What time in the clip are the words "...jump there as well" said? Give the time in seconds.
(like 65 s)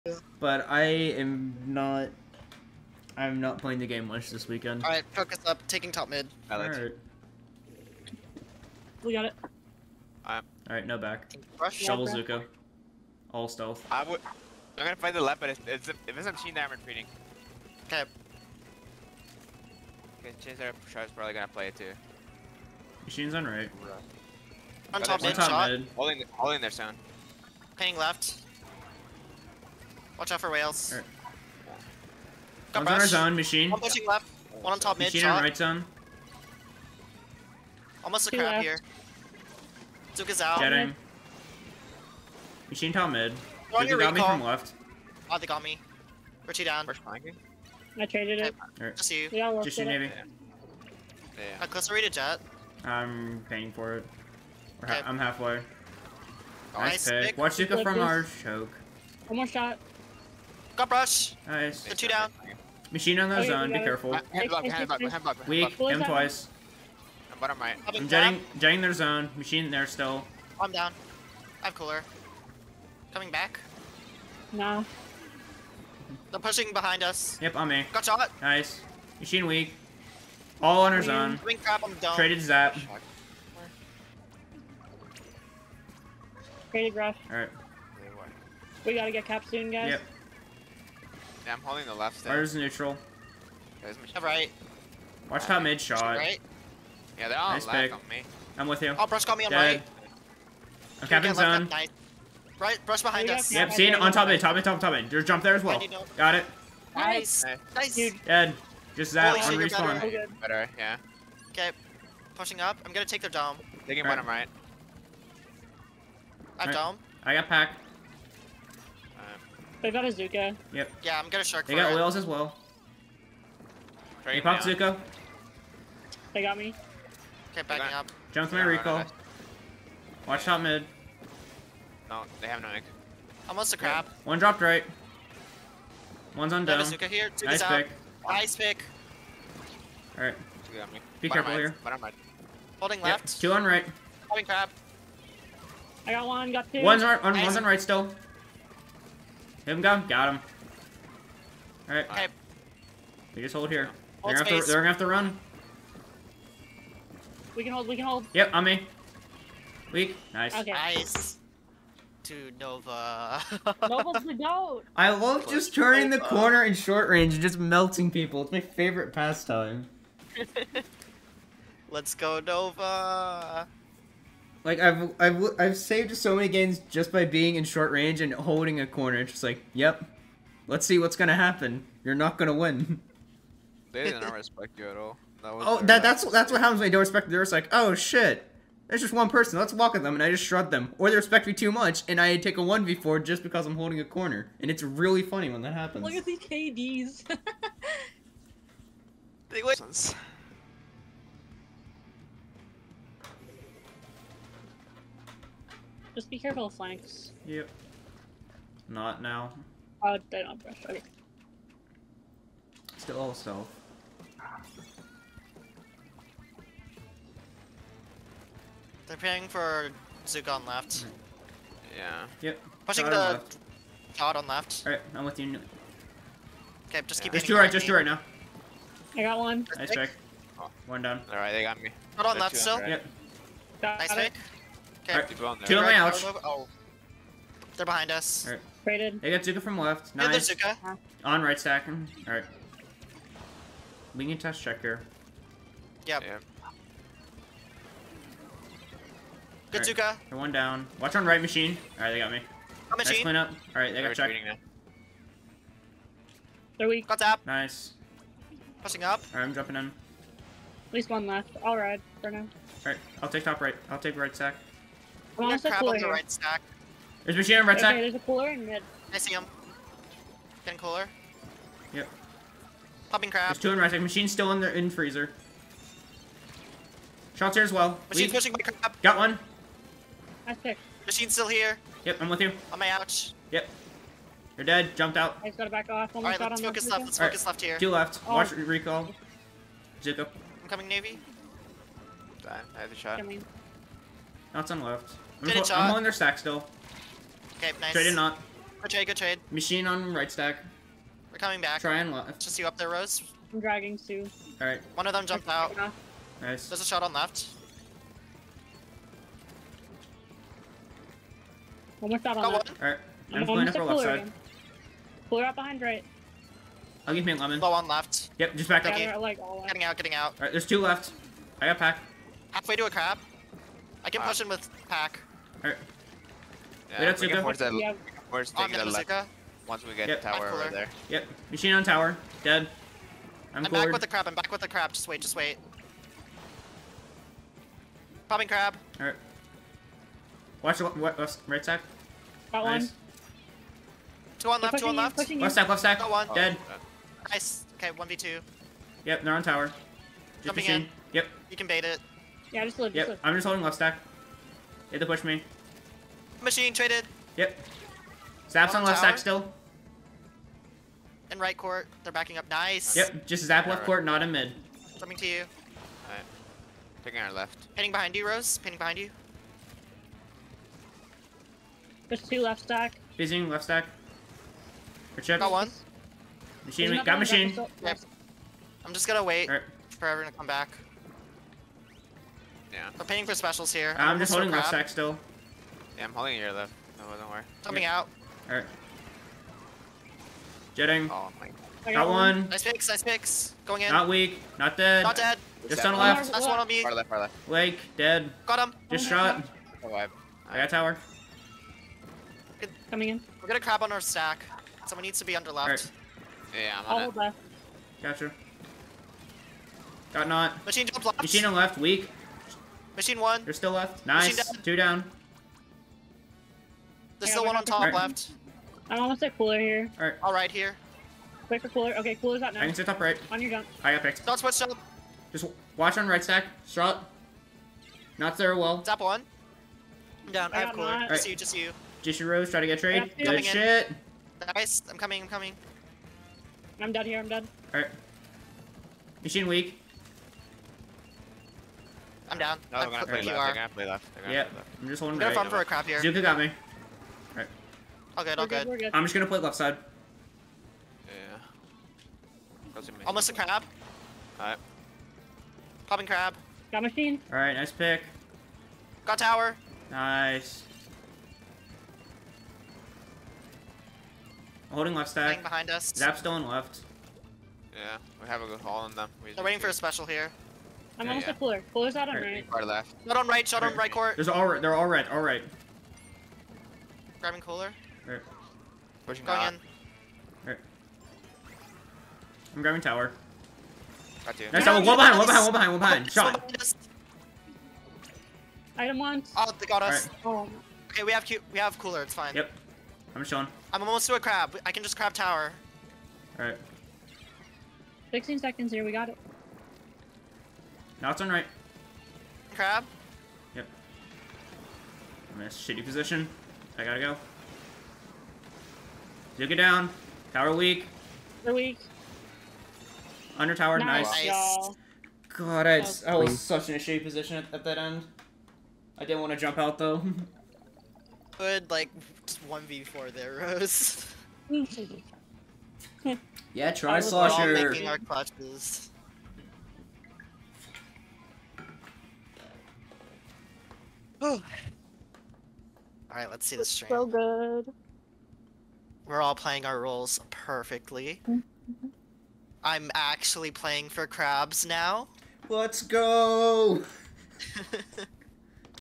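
105 s.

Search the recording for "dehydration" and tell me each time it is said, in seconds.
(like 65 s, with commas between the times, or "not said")
not said.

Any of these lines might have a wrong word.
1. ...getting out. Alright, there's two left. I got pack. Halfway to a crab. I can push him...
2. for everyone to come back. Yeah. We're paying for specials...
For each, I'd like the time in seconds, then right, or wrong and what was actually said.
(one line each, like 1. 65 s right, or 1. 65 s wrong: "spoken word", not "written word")
1. 319 s right
2. 379 s right.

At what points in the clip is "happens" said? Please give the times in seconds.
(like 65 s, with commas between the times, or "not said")
181 s, 186 s, 195 s.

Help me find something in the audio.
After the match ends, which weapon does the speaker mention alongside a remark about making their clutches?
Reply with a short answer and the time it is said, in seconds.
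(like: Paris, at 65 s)
Slosher, at 526 s.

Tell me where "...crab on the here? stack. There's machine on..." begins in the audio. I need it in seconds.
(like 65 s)
265 s.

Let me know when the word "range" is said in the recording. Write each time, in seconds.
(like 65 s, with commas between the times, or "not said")
167 s, 177 s.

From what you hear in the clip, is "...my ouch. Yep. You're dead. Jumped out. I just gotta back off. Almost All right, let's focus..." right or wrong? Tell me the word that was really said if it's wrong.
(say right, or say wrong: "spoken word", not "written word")
right.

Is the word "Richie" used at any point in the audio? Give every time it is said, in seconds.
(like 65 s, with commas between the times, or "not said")
46 s.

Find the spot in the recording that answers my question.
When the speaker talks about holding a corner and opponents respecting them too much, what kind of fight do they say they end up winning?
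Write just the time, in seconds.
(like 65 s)
192 s.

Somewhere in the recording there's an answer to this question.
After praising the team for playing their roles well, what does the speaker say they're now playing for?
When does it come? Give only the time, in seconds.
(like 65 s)
544 s.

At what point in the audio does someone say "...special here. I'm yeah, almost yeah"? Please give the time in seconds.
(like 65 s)
469 s.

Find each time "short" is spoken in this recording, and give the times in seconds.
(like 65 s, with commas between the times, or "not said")
166 s, 177 s.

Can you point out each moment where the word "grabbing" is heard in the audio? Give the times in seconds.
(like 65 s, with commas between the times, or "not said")
477 s, 482 s.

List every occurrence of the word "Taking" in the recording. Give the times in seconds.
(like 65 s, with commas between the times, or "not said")
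5 s, 367 s.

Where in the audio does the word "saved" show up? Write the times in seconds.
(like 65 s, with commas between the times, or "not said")
175 s.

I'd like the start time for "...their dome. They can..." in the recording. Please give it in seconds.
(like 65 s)
113 s.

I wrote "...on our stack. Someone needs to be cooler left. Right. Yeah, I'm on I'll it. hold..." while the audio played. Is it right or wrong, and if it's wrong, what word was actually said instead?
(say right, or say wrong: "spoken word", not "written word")
wrong: "under", not "cooler".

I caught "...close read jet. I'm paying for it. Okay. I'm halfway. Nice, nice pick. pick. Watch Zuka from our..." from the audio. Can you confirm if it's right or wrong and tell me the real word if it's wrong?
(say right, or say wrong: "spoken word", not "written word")
right.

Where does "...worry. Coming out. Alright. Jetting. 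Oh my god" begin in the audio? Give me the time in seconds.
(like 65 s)
387 s.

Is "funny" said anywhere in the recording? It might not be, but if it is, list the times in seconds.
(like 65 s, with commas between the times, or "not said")
195 s.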